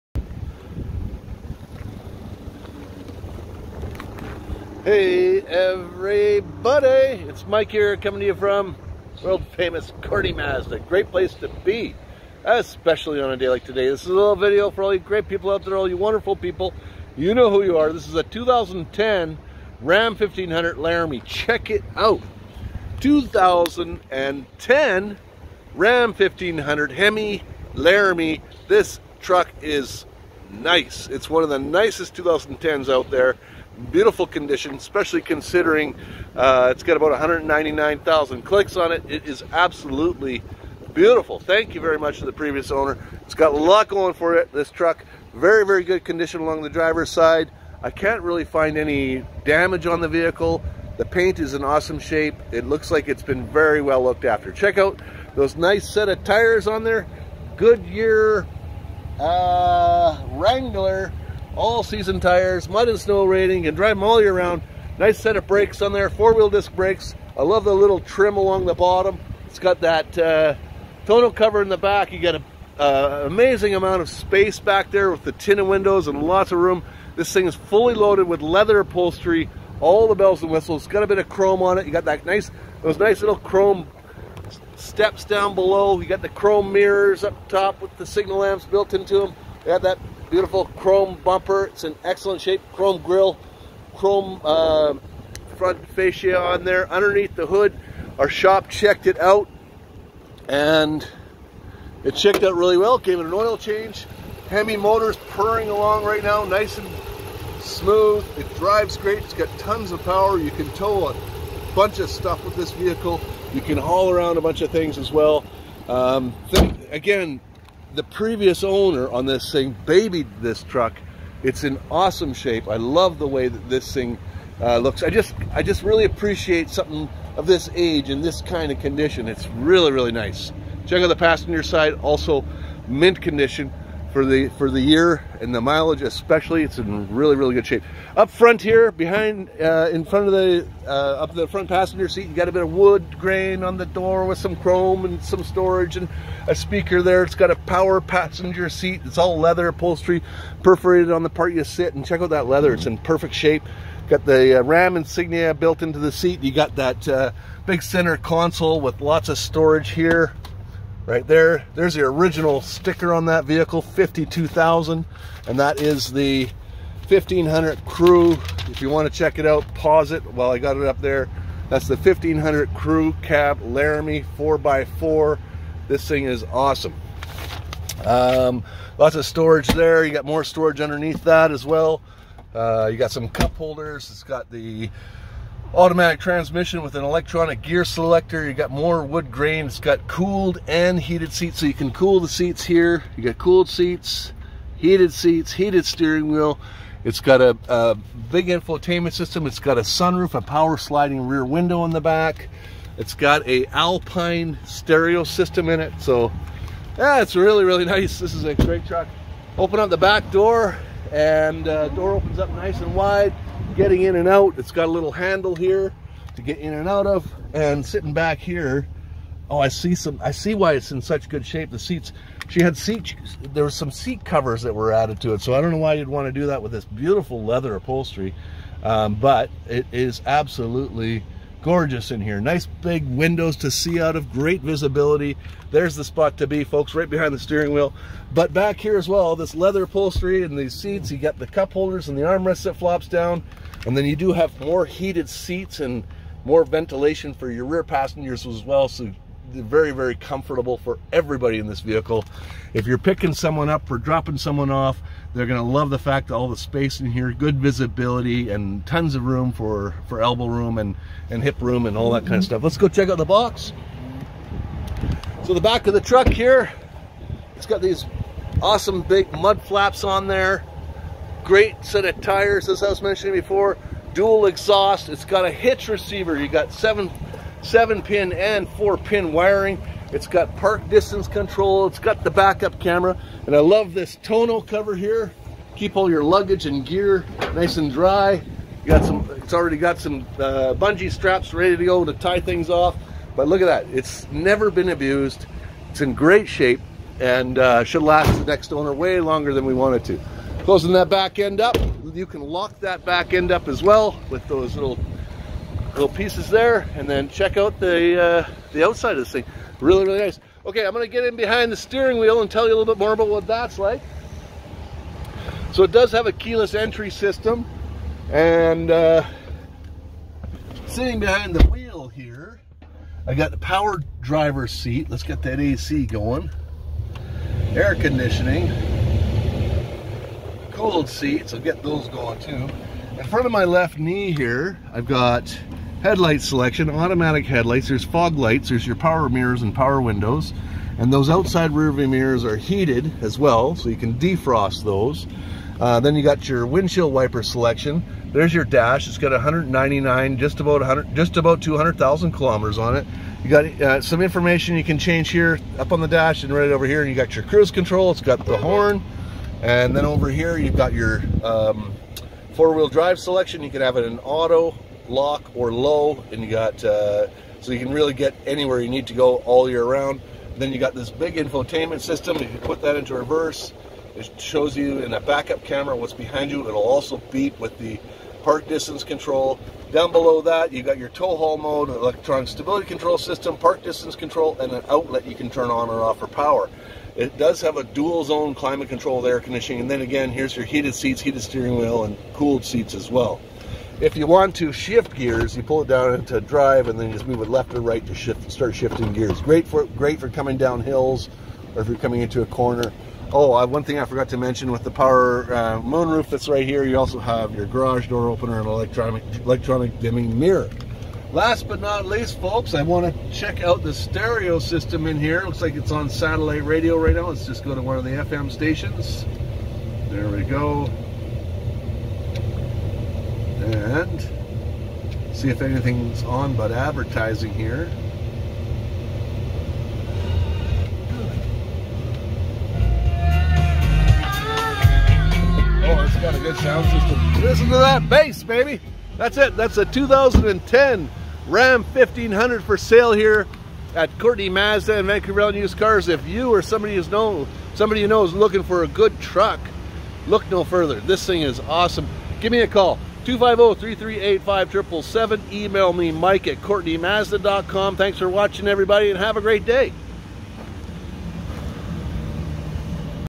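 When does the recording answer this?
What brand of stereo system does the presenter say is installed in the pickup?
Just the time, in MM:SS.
03:23.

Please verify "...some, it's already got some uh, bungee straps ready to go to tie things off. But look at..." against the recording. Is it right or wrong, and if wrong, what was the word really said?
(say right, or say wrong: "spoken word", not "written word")
right.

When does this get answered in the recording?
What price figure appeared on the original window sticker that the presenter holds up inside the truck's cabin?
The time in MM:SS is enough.
02:43.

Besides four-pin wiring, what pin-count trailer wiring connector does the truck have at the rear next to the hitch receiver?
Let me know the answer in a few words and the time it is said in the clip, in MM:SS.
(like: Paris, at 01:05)
7 pin, at 04:36.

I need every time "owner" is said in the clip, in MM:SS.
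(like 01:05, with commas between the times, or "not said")
00:42, 01:58, 04:58.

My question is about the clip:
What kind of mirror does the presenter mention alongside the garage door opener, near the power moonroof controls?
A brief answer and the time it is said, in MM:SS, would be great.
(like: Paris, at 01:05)
electronic dimming mirror, at 06:49.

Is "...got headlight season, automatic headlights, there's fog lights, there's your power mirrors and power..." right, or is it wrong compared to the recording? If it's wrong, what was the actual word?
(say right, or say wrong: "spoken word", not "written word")
wrong: "selection", not "season".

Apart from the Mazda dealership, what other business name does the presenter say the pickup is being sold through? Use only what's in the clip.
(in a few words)
Vancouver Island Used Cars.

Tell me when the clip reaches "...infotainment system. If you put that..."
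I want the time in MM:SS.
06:11.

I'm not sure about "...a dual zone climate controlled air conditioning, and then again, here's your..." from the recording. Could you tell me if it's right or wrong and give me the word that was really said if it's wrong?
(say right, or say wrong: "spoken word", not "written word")
right.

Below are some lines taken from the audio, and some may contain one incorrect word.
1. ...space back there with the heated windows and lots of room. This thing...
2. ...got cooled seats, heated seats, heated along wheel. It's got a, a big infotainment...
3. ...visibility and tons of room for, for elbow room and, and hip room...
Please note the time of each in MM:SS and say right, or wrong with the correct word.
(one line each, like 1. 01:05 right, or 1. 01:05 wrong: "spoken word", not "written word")
1. 01:14 wrong: "tinted", not "heated"
2. 03:13 wrong: "steering", not "along"
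3. 04:17 right.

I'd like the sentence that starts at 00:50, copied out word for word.
The paint is in awesome shape.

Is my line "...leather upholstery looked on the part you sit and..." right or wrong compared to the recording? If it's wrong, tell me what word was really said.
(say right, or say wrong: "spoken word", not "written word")
wrong: "perforated", not "looked".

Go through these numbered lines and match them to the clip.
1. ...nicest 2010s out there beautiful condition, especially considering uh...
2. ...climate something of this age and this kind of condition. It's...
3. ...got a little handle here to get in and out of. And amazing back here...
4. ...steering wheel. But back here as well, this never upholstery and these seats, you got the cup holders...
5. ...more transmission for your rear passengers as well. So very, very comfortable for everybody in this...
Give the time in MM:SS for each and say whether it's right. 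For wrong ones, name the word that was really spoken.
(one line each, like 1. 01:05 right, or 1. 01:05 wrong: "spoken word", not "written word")
1. 00:31 right
2. 02:06 wrong: "appreciate", not "climate"
3. 03:34 wrong: "sitting", not "amazing"
4. 03:57 wrong: "leather", not "never"
5. 04:06 wrong: "ventilation", not "transmission".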